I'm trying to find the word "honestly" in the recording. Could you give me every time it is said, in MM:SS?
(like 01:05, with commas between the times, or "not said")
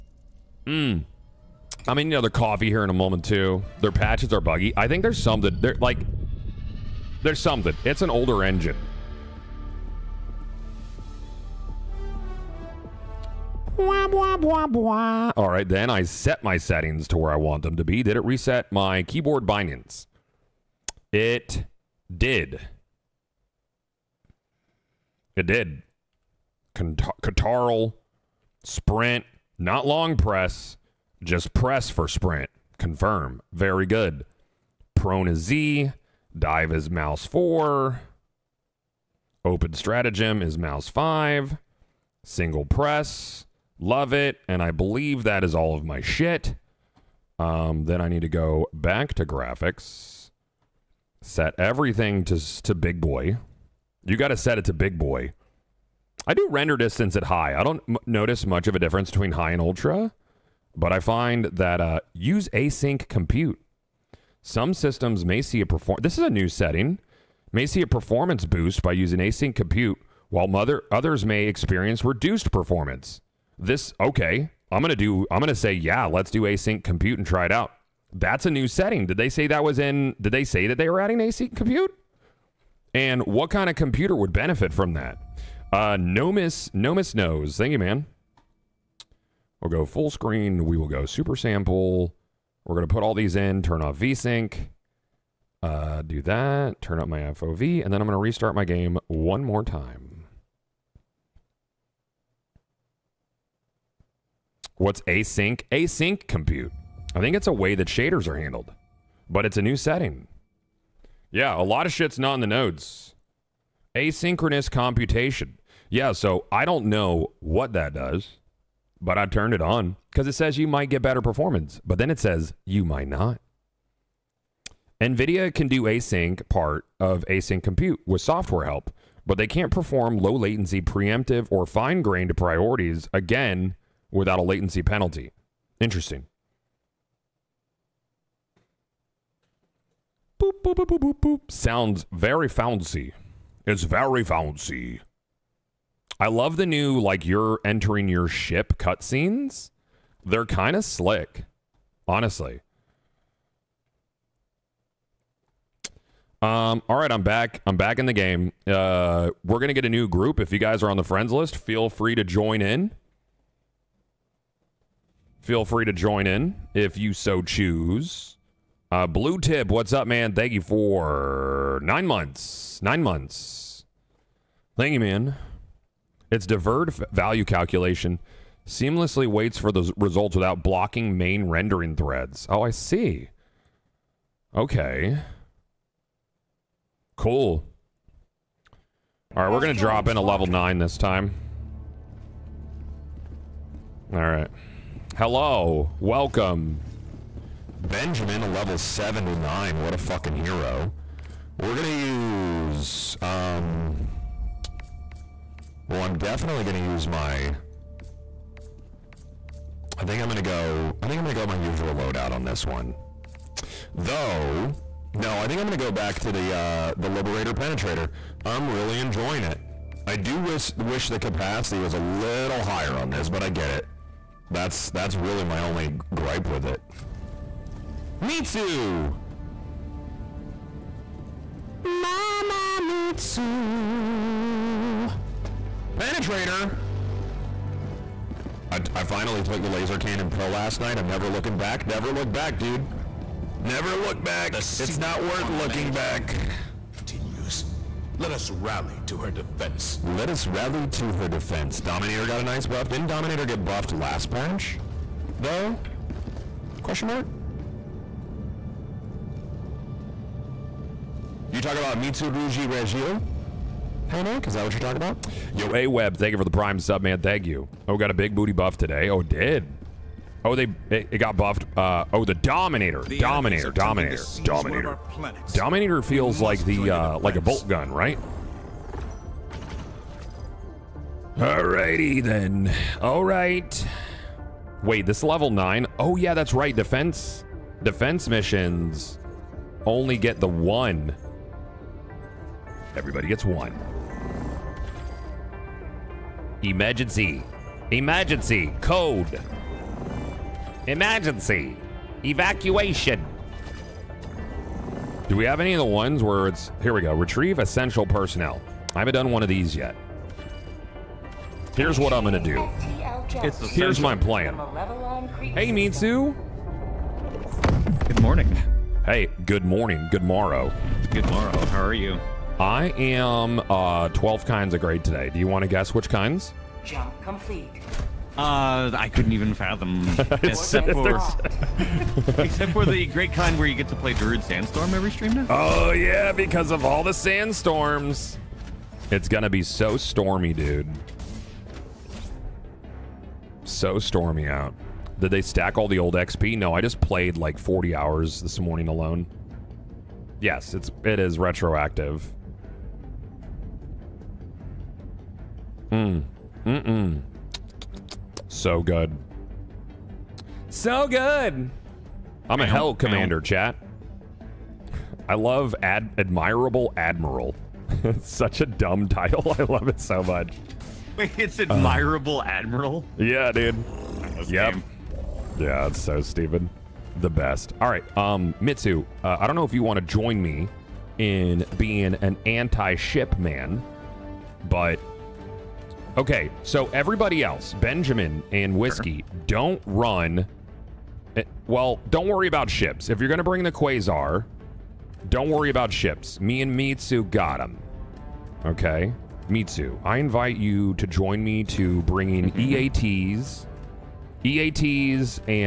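02:32.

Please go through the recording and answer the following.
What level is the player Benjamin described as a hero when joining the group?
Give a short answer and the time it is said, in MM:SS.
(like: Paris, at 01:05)
79, at 03:18.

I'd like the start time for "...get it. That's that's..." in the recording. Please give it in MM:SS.
03:43.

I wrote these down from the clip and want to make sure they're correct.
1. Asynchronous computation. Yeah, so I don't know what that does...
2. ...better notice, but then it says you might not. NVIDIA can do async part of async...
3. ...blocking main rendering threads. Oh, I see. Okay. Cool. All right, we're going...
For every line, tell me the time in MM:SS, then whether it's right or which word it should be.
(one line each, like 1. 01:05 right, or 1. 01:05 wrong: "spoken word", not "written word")
1. 01:53 right
2. 02:01 wrong: "performance", not "notice"
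3. 03:00 right.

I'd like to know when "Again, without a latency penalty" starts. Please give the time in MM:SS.
02:13.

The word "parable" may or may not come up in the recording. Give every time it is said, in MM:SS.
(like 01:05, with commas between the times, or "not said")
not said.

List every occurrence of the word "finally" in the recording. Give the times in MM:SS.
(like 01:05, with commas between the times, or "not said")
03:59.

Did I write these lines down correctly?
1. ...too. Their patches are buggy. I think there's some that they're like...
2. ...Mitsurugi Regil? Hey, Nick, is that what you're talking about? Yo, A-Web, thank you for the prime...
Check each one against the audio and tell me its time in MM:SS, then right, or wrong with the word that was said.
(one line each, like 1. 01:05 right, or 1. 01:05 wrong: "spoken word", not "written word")
1. 00:03 right
2. 04:21 right.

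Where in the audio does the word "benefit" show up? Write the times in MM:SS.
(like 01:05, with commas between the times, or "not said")
01:24.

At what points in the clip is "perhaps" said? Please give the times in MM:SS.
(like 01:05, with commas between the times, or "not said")
not said.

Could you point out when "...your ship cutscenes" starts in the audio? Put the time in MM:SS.
02:28.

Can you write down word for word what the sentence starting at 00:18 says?
Did it reset my keyboard bindings?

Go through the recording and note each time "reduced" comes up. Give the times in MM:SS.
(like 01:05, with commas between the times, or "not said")
01:12.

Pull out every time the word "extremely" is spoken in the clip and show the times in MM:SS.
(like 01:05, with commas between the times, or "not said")
not said.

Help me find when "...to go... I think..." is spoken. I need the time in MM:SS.
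03:30.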